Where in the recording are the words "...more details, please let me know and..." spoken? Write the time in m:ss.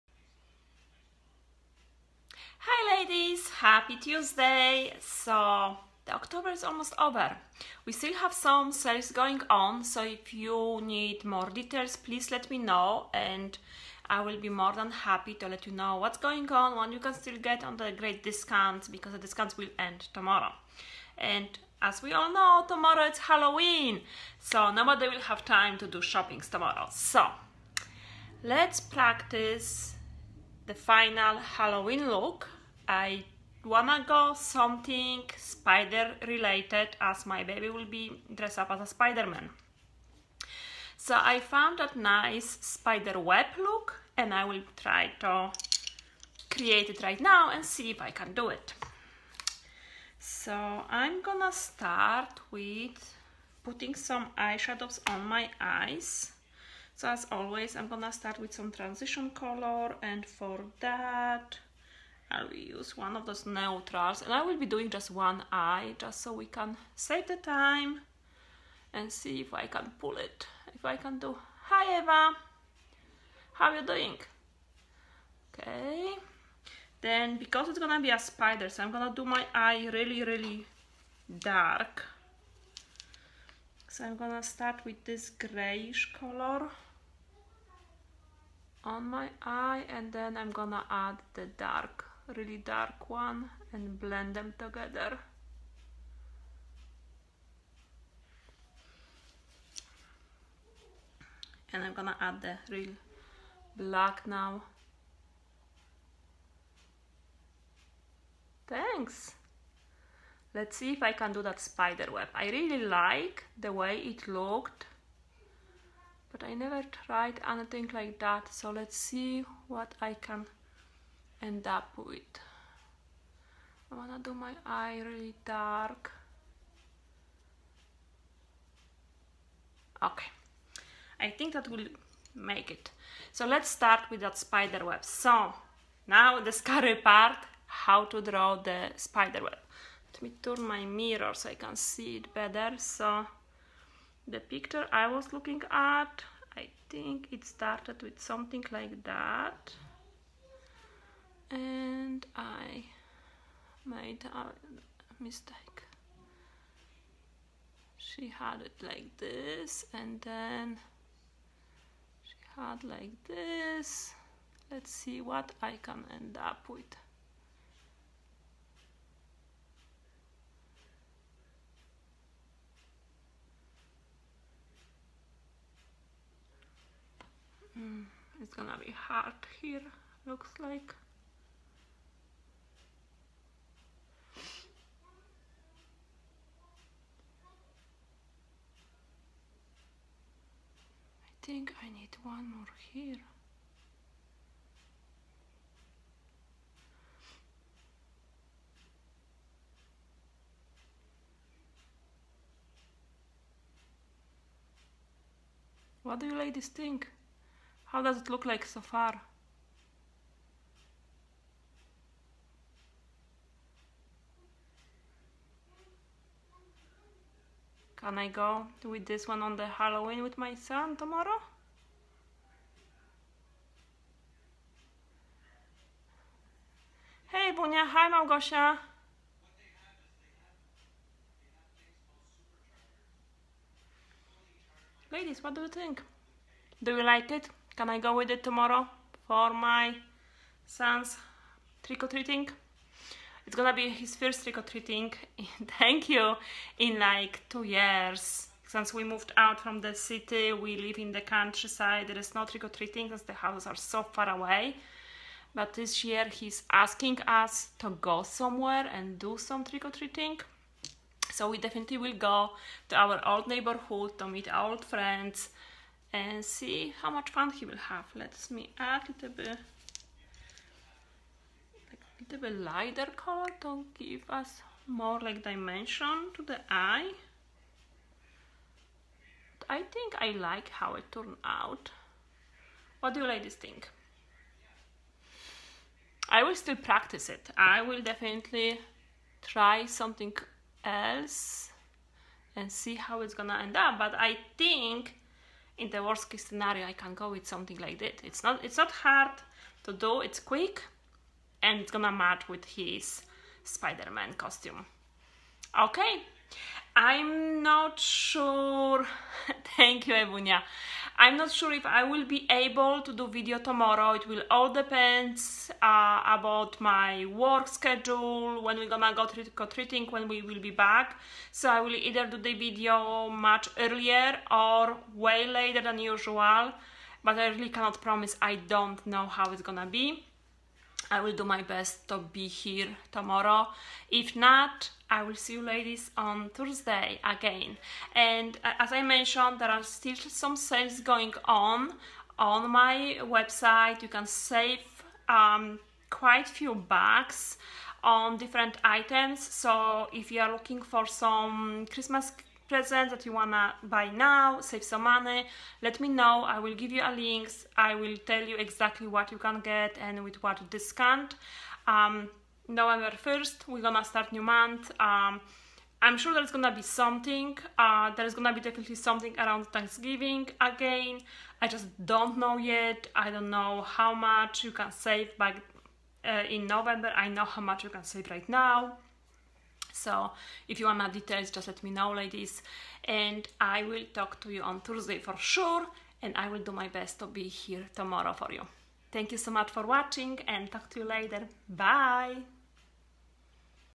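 0:11.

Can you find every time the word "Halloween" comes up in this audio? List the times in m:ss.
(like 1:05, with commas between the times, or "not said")
0:23, 0:31, 3:39.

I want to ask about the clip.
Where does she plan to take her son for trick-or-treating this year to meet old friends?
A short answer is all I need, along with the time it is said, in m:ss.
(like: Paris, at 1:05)
our old neighborhood, at 4:22.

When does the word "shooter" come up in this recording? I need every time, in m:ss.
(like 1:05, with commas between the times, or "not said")
not said.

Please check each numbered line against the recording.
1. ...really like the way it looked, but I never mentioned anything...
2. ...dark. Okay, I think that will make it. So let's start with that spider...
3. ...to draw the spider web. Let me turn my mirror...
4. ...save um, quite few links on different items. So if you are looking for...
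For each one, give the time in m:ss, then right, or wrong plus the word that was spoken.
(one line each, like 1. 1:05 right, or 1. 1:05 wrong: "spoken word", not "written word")
1. 1:52 wrong: "tried", not "mentioned"
2. 2:05 right
3. 2:18 right
4. 5:44 wrong: "bucks", not "links".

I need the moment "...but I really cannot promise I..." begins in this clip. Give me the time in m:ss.
5:27.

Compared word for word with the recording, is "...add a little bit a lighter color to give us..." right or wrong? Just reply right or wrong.
right.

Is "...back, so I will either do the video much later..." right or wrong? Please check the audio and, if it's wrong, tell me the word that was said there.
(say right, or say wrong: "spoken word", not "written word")
wrong: "earlier", not "later".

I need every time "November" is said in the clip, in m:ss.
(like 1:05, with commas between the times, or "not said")
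6:02, 6:16.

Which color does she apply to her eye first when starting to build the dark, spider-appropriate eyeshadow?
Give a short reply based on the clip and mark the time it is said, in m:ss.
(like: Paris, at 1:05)
grayish color, at 1:25.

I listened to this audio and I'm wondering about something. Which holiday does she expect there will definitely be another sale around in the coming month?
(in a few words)
Thanksgiving.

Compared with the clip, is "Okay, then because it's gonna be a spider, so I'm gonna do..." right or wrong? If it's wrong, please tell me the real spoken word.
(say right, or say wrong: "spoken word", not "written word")
right.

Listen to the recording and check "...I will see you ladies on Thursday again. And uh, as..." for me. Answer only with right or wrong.
right.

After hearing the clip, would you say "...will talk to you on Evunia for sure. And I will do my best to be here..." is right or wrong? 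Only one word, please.
wrong.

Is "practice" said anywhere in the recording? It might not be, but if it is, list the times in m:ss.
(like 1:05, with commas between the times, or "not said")
0:28, 4:46.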